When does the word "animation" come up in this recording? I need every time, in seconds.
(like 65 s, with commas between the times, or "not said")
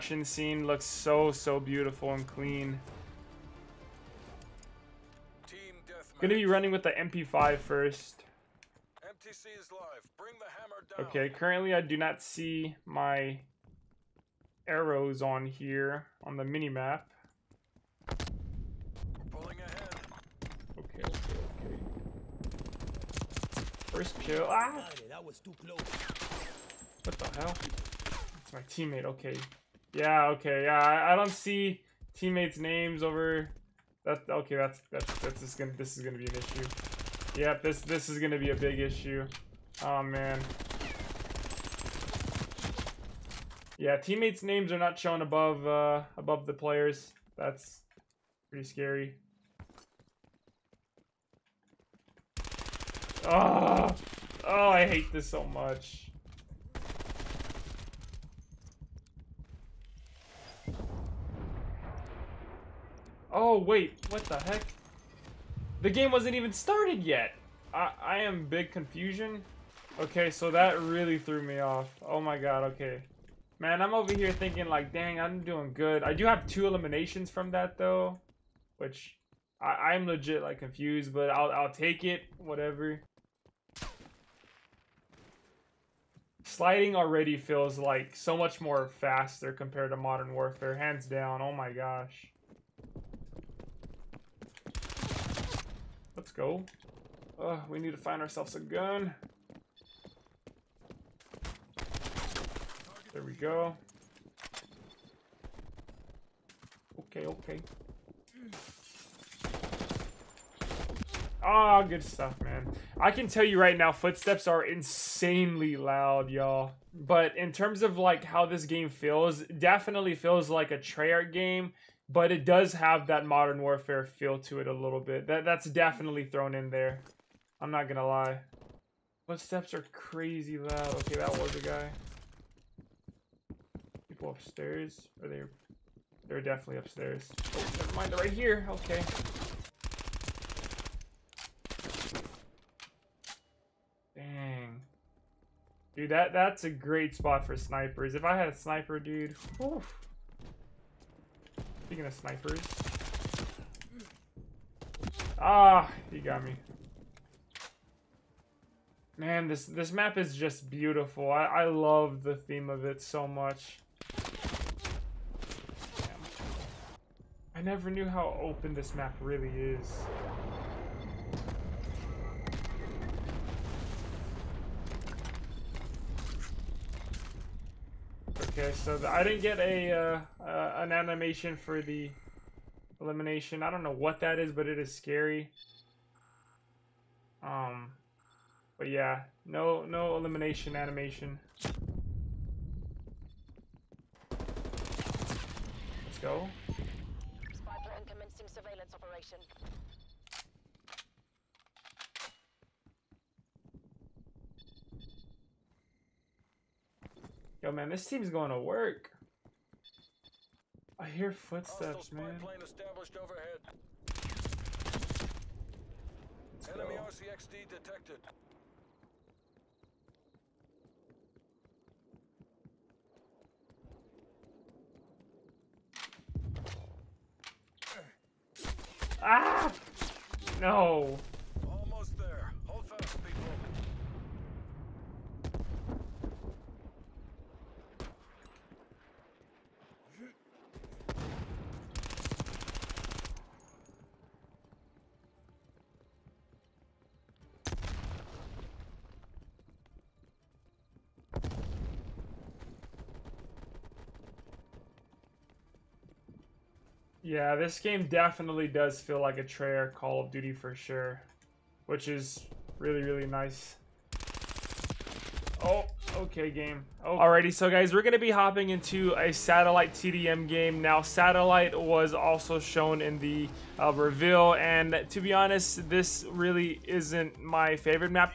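180 s, 190 s.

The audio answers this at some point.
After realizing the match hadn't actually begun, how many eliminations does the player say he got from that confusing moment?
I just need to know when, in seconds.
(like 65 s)
76 s.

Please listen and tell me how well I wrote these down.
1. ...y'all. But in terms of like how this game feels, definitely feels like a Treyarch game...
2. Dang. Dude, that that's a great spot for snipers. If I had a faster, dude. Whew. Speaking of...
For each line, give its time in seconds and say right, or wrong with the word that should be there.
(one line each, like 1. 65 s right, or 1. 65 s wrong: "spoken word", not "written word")
1. 116 s right
2. 144 s wrong: "sniper", not "faster".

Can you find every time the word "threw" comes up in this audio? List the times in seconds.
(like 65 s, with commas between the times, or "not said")
71 s.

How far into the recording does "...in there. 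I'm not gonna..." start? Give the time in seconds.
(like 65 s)
126 s.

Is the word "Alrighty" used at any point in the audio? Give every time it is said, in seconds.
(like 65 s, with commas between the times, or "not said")
267 s.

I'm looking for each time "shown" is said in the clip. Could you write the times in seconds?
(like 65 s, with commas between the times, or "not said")
44 s, 272 s.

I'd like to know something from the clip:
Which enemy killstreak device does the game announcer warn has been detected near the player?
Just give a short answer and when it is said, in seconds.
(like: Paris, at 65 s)
RCXD, at 217 s.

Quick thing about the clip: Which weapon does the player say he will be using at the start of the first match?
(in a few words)
MP5.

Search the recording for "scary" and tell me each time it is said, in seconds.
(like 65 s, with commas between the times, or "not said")
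48 s, 184 s.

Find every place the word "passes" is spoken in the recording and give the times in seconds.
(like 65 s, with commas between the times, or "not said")
not said.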